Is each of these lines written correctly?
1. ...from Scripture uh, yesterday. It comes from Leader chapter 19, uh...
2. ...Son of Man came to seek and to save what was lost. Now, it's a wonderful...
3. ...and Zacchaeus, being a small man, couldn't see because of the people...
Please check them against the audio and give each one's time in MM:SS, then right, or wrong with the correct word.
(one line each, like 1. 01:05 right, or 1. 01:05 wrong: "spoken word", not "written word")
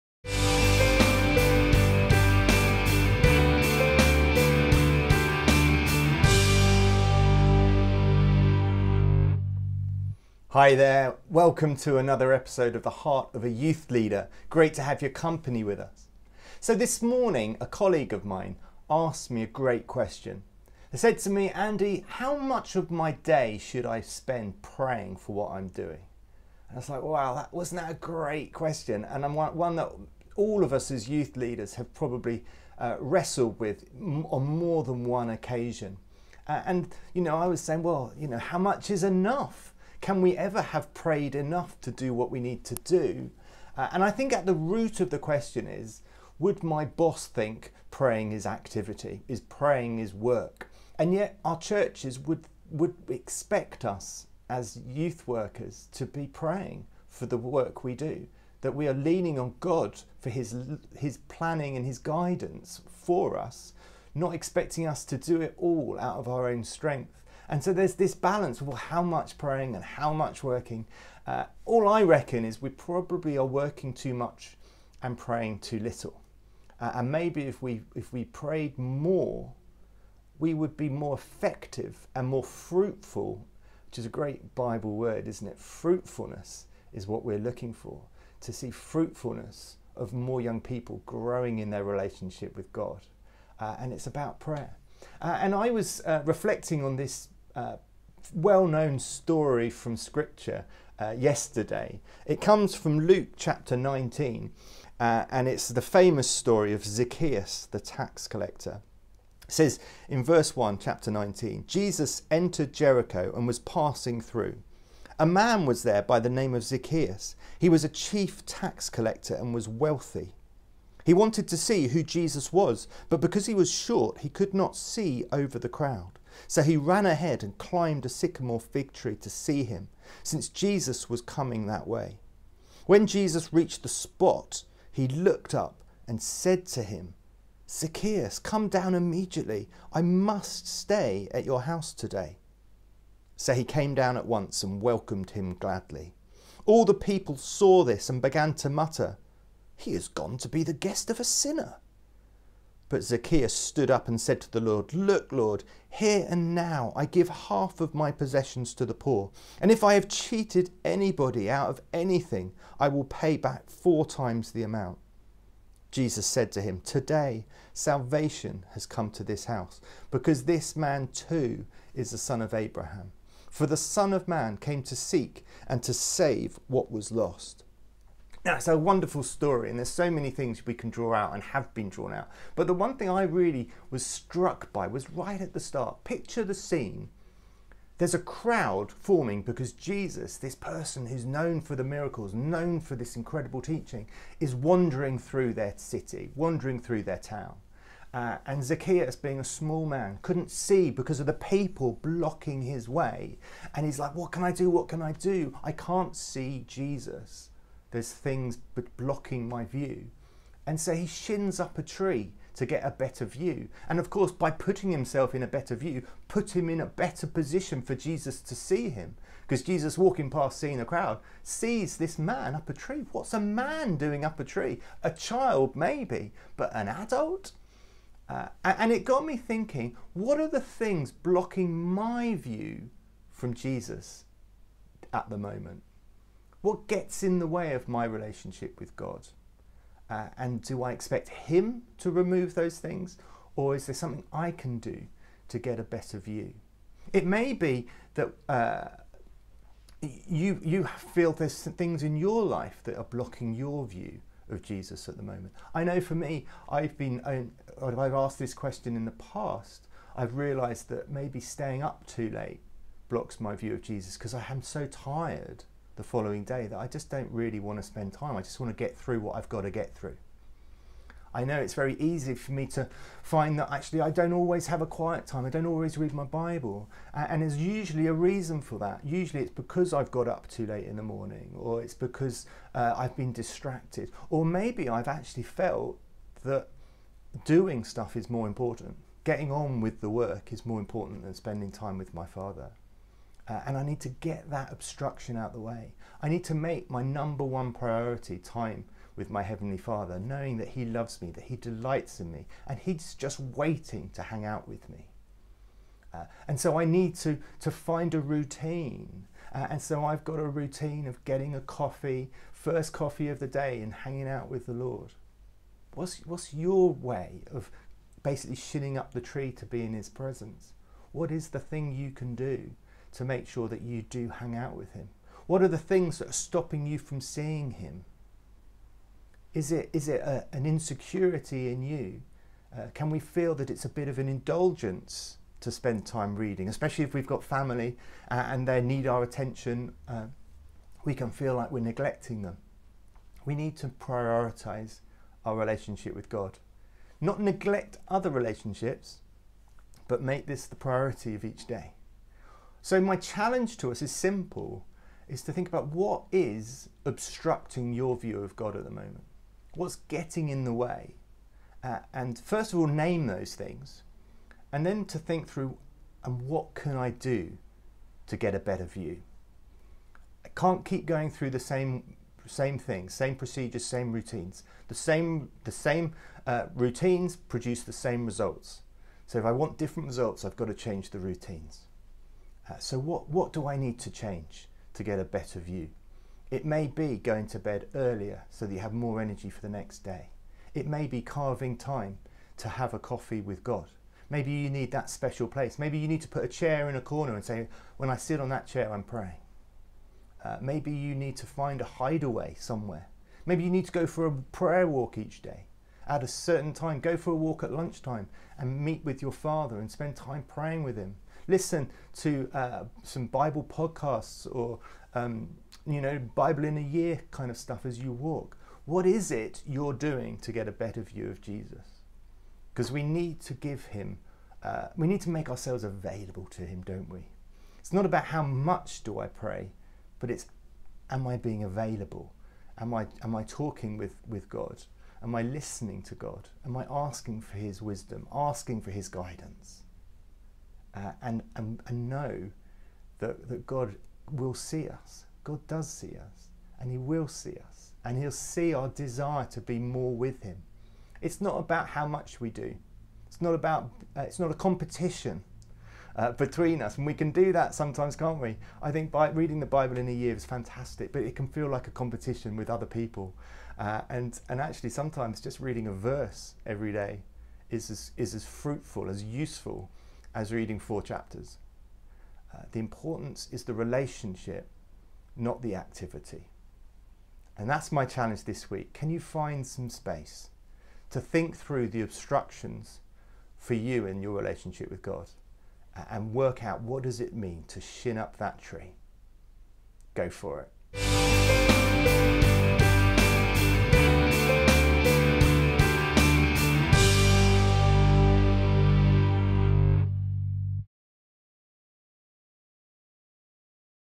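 1. 01:39 wrong: "Luke", not "Leader"
2. 02:53 right
3. 03:18 right.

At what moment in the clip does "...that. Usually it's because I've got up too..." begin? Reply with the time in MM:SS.
04:38.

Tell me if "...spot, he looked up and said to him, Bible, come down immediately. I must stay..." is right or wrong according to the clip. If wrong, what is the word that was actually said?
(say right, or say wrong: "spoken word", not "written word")
wrong: "Zacchaeus", not "Bible".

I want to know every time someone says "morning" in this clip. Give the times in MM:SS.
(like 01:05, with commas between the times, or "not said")
00:17, 04:41.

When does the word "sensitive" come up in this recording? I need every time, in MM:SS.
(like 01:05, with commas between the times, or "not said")
not said.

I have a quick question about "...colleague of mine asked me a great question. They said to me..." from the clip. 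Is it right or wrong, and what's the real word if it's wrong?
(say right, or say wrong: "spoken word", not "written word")
right.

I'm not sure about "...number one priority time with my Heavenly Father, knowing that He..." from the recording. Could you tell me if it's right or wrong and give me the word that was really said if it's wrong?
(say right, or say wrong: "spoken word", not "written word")
right.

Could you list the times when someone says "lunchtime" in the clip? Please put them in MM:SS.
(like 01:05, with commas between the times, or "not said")
06:47.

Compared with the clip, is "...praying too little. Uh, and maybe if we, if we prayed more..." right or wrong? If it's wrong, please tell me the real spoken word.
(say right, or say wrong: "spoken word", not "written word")
right.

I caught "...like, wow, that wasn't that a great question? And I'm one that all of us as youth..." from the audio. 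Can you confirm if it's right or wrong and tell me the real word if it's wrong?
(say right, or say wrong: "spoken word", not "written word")
right.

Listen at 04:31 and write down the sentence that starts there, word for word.
I know it's very easy for me to find that actually I don't always have a quiet time.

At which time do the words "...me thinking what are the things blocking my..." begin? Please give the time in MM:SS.
03:49.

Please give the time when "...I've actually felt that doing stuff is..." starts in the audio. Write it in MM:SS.
04:44.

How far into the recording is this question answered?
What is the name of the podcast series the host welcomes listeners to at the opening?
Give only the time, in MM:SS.
00:12.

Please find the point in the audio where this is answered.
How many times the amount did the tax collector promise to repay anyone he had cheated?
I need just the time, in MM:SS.
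02:43.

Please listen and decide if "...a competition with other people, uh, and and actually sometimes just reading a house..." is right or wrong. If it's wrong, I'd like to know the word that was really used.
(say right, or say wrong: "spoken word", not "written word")
wrong: "verse", not "house".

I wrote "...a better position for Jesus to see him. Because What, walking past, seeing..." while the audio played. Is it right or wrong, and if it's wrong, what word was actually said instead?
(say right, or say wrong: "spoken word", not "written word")
wrong: "Jesus", not "What".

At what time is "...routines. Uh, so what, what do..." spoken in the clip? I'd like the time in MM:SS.
06:21.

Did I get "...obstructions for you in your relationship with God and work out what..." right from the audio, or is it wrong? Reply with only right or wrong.
right.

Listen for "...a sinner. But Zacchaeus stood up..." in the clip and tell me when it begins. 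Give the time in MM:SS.
02:31.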